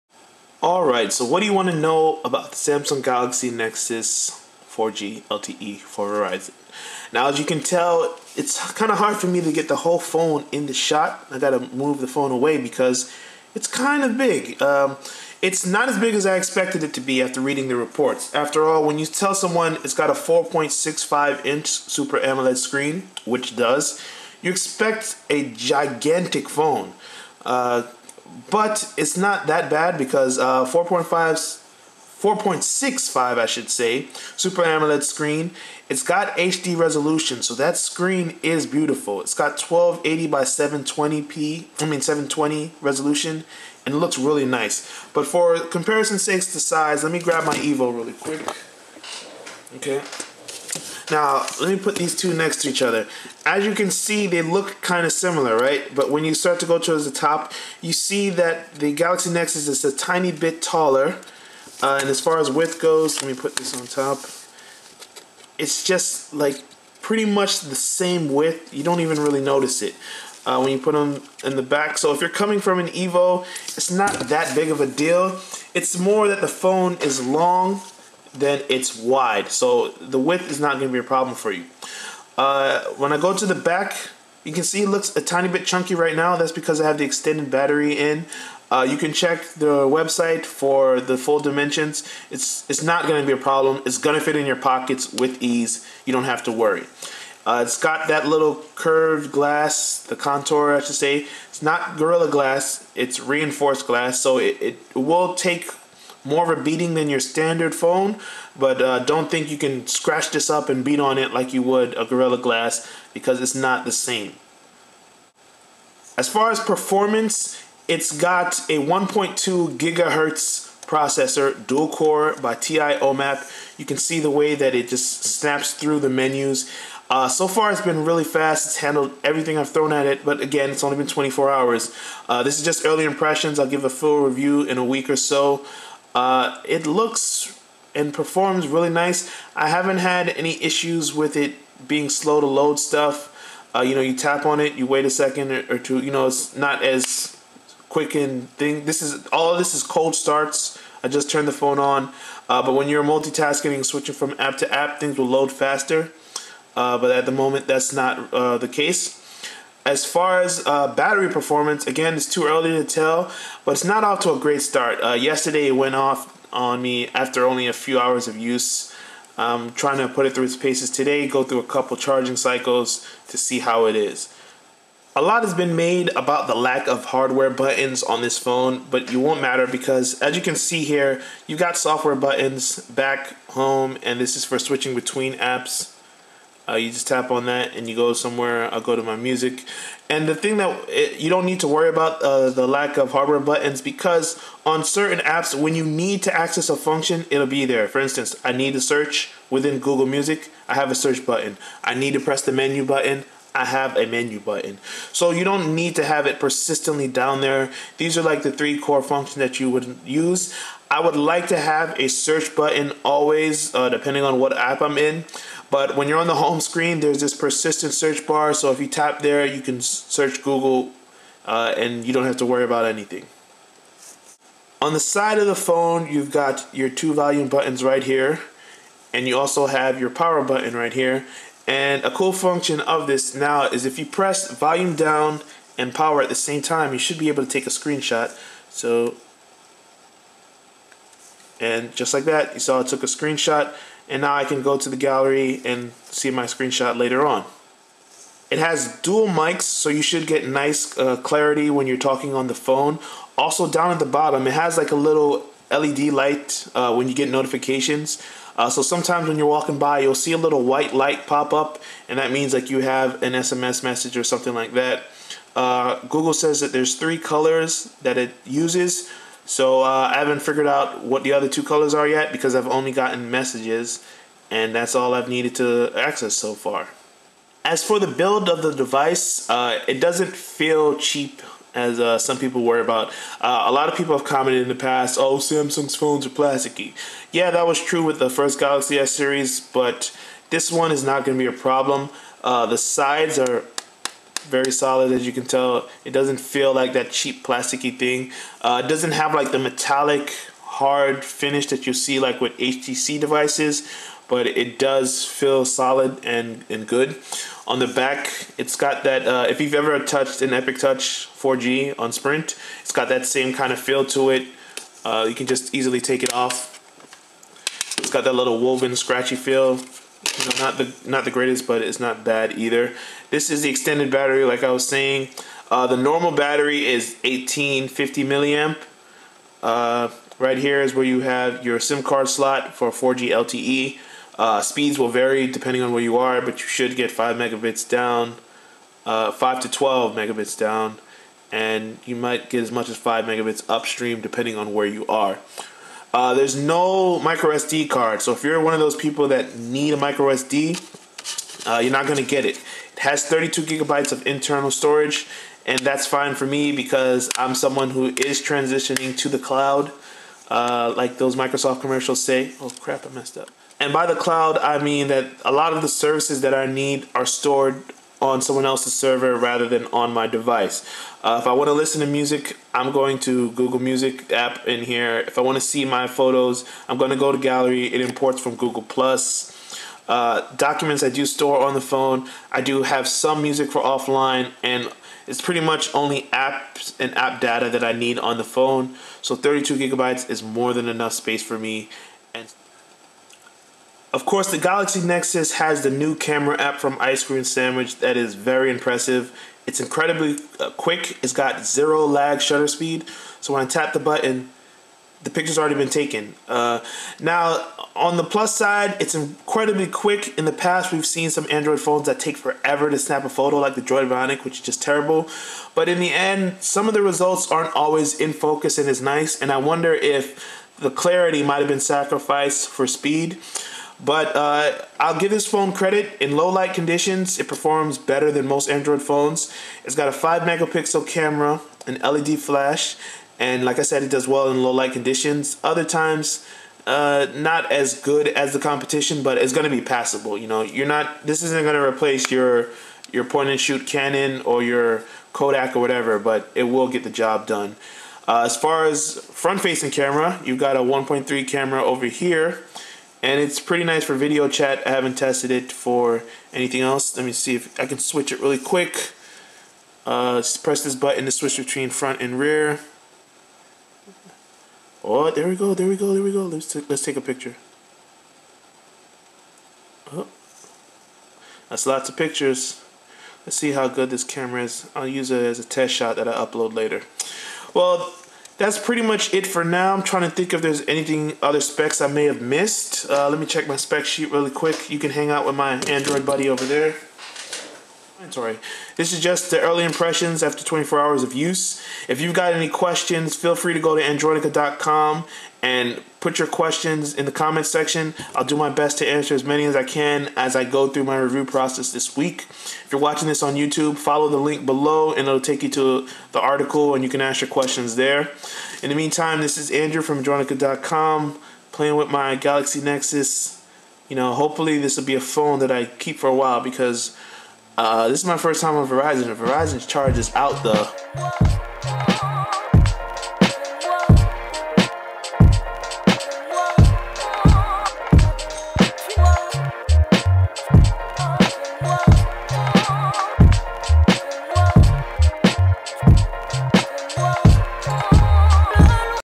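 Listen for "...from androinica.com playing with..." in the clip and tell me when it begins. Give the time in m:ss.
8:30.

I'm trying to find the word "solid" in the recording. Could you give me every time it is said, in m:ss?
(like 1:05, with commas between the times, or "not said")
4:54, 5:05.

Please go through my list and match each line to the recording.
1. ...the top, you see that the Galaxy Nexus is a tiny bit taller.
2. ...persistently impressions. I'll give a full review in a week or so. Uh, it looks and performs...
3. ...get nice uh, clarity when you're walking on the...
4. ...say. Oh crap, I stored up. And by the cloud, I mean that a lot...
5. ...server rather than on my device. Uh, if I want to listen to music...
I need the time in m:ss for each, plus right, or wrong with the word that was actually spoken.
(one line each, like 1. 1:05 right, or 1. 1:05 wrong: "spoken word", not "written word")
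1. 0:57 right
2. 2:12 wrong: "early", not "persistently"
3. 4:10 wrong: "talking", not "walking"
4. 6:02 wrong: "messed", not "stored"
5. 6:08 right.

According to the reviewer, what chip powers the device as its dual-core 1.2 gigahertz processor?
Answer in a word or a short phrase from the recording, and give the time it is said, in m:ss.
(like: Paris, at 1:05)
TI OMAP, at 2:02.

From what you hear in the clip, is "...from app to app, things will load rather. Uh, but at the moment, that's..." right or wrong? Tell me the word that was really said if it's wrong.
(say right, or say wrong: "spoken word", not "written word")
wrong: "faster", not "rather".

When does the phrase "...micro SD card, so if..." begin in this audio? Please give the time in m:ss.
5:47.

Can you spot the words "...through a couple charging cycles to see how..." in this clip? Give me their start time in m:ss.
2:51.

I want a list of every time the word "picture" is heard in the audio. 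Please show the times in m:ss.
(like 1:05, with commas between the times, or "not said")
6:45, 7:47, 7:52.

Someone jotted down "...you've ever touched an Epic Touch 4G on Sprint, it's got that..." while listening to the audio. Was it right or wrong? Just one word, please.
right.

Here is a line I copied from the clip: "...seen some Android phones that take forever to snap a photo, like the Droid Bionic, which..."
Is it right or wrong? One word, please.
right.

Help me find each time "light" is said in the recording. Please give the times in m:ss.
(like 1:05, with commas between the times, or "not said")
4:16, 4:20, 7:06, 7:14.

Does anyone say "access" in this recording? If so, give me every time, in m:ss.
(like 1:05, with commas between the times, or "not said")
3:16, 4:35.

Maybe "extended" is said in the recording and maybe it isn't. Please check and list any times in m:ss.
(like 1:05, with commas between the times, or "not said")
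1:27, 5:23.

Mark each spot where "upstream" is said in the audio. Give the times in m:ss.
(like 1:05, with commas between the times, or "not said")
5:43.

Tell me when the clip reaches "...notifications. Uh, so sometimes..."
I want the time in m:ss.
4:17.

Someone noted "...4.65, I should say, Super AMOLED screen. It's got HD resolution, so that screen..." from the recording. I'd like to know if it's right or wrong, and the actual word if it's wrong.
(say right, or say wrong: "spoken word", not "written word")
right.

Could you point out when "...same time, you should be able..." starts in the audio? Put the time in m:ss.
3:56.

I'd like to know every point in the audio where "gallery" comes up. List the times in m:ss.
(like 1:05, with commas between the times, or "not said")
4:04, 6:17.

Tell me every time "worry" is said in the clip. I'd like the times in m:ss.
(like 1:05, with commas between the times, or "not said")
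1:36, 3:11, 3:42, 4:42.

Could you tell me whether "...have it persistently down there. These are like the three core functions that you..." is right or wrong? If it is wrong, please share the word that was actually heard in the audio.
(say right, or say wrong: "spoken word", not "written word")
right.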